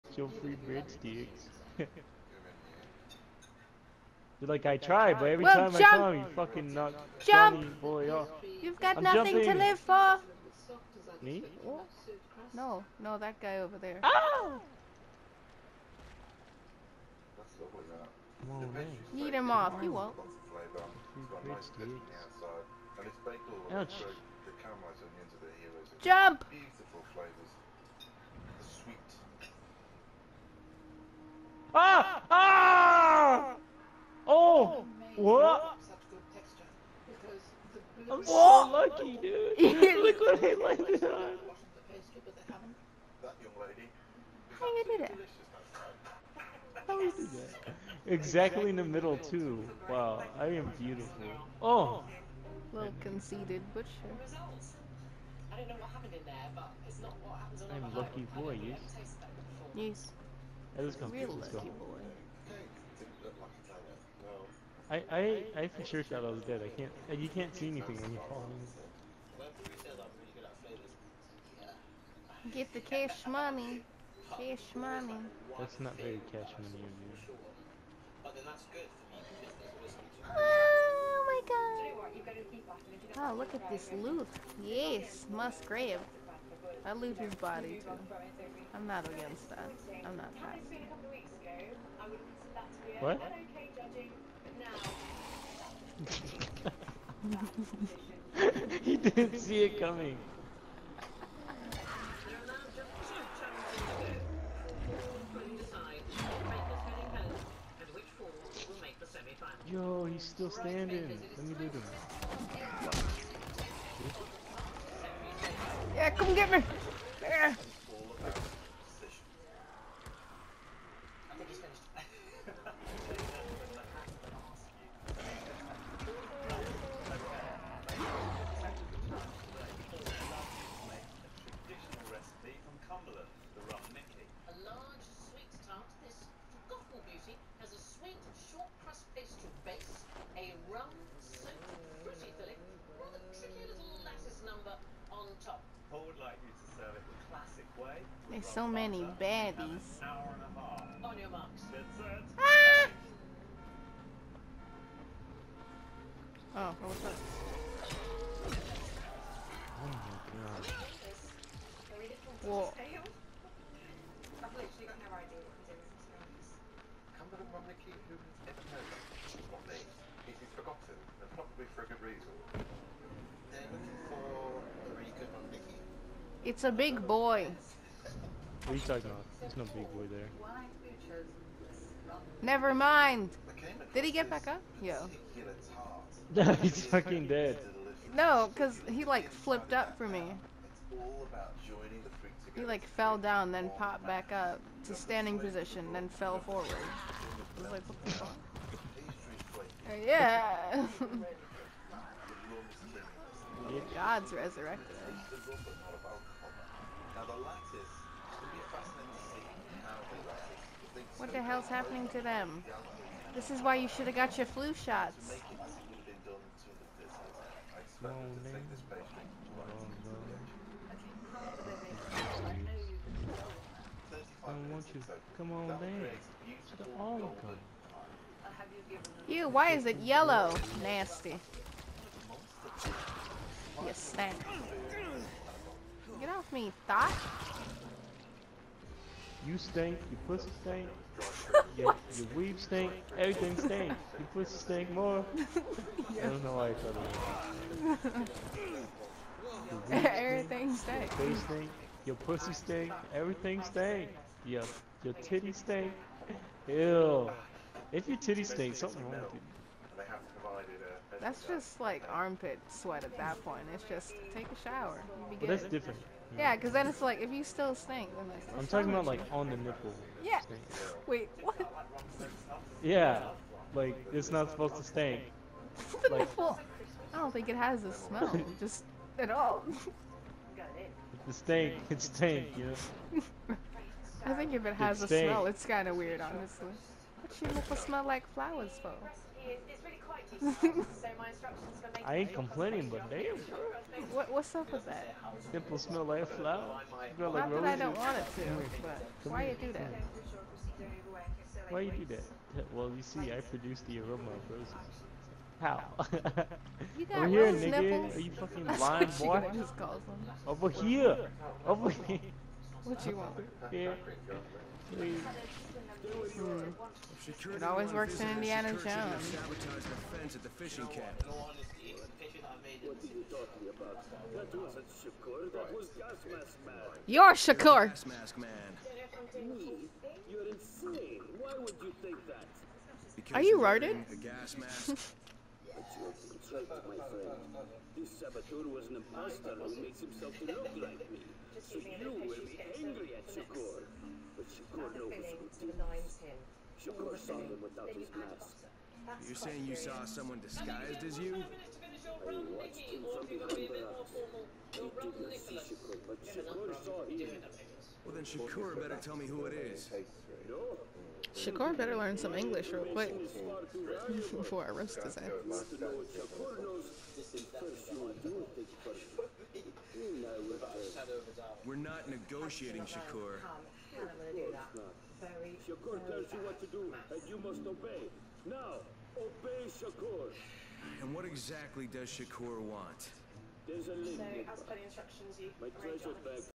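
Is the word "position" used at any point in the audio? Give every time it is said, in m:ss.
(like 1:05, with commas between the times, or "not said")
3:15.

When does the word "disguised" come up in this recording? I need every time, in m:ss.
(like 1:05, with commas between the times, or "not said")
5:50.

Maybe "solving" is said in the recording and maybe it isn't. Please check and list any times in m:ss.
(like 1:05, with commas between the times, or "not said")
not said.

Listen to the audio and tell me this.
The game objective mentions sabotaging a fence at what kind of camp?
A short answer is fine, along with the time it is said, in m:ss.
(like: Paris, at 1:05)
fishing camp, at 5:20.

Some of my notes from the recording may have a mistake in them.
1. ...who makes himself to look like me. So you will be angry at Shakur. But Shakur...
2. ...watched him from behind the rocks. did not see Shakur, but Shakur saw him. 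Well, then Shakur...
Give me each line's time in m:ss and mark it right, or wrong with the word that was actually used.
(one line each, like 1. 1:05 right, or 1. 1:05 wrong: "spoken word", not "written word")
1. 5:39 right
2. 5:52 right.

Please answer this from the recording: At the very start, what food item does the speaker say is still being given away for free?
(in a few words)
breadsticks.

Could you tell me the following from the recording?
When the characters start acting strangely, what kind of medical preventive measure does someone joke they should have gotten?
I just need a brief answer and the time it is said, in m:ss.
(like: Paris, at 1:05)
flu shots, at 3:34.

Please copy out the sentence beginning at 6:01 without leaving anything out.
Shakur better learn some English real quick before I roast his ass.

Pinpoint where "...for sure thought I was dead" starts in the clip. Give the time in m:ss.
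1:05.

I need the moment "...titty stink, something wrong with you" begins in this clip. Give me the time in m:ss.
4:18.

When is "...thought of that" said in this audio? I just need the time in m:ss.
4:07.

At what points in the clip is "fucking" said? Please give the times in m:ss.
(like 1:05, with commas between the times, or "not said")
0:06, 3:06, 5:08.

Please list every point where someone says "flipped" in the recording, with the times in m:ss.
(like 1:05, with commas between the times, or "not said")
3:09.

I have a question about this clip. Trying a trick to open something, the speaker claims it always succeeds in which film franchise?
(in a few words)
Indiana Jones.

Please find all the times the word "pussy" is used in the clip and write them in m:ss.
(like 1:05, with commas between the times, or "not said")
4:00, 4:04, 4:12.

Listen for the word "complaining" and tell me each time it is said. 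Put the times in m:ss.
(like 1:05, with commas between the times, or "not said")
4:52.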